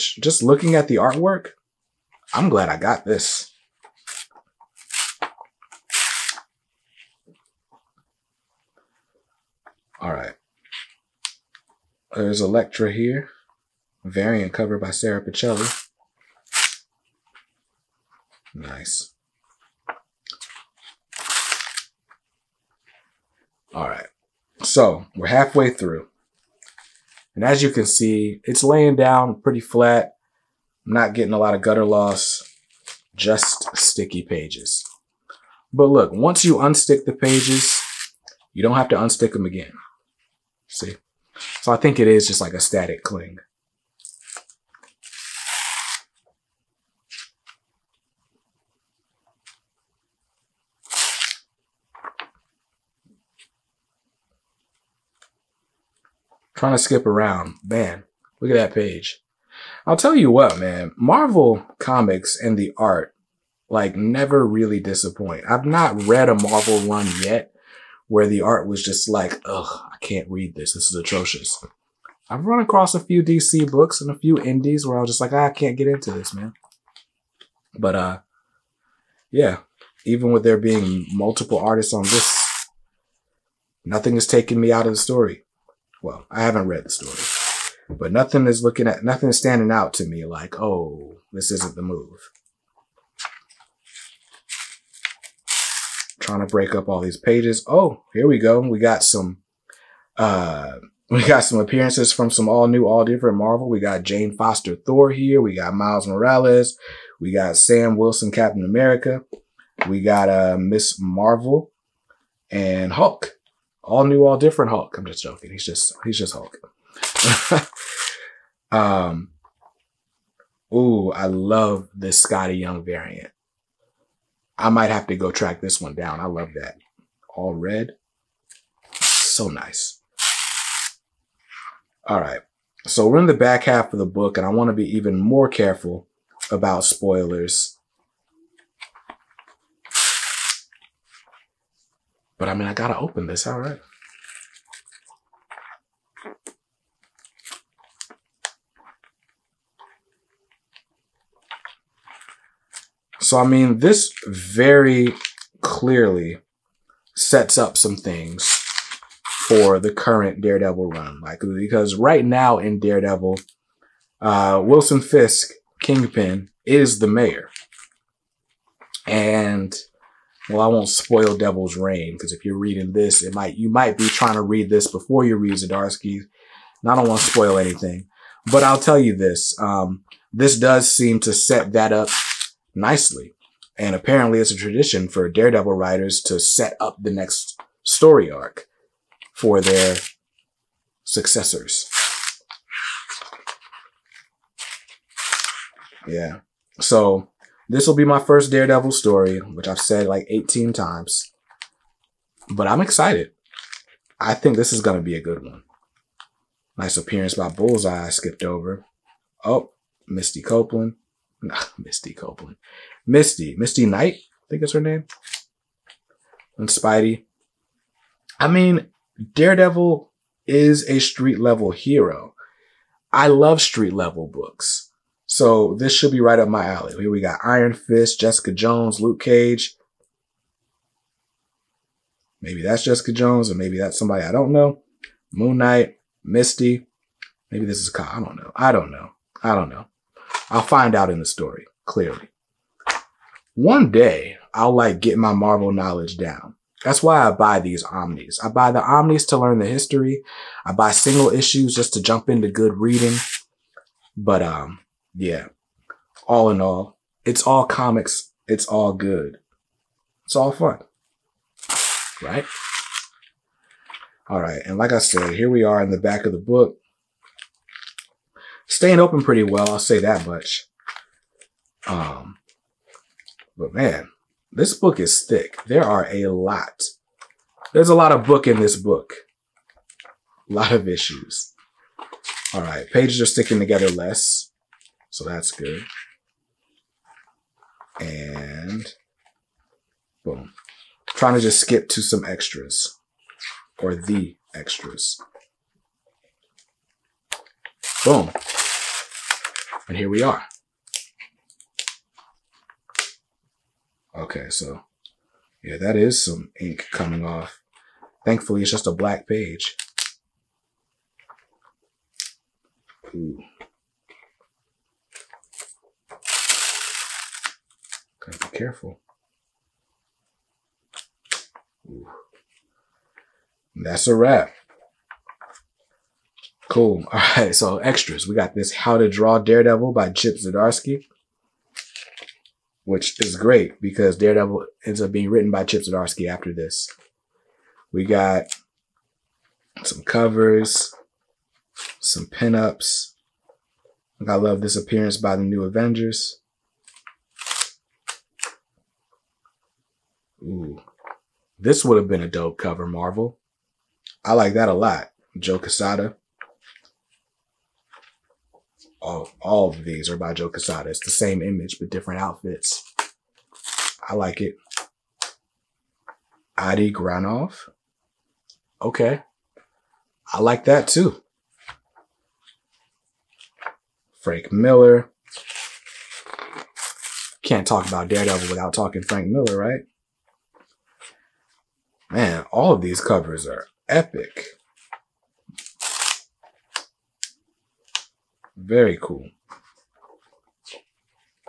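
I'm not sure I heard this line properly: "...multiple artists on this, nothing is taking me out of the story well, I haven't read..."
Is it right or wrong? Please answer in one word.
right.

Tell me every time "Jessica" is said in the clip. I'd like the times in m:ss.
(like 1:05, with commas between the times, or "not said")
3:48, 3:52.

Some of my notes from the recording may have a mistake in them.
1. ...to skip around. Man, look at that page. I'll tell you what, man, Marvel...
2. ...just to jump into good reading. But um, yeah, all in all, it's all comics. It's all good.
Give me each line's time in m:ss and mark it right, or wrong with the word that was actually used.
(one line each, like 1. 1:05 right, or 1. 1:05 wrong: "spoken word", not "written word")
1. 0:56 right
2. 4:11 right.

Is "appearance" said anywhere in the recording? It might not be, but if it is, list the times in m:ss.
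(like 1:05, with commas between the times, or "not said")
1:41, 3:26, 5:44.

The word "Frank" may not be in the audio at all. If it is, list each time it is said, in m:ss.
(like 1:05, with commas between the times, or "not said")
6:14, 6:19.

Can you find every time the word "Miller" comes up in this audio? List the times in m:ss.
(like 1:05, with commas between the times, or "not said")
6:14, 6:19.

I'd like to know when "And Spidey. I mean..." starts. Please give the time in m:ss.
3:36.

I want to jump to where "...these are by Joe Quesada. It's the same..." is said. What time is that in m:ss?
5:59.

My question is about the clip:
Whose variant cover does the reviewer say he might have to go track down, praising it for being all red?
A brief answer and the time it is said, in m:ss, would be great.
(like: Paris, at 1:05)
Skottie Young, at 2:02.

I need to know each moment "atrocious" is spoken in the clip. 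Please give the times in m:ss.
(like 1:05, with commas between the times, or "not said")
1:10.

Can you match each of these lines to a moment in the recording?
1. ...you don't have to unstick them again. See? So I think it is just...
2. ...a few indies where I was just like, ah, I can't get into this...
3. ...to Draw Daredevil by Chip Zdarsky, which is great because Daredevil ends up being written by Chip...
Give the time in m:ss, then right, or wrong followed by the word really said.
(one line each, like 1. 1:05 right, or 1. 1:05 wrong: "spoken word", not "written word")
1. 0:38 right
2. 1:14 right
3. 5:28 right.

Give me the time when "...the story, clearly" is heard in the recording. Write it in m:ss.
4:01.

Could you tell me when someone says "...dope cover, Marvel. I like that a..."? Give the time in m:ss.
5:52.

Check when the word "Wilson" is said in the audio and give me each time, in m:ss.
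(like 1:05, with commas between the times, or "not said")
1:47, 2:44.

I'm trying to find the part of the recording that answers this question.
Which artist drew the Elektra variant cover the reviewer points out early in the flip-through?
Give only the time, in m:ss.
0:14.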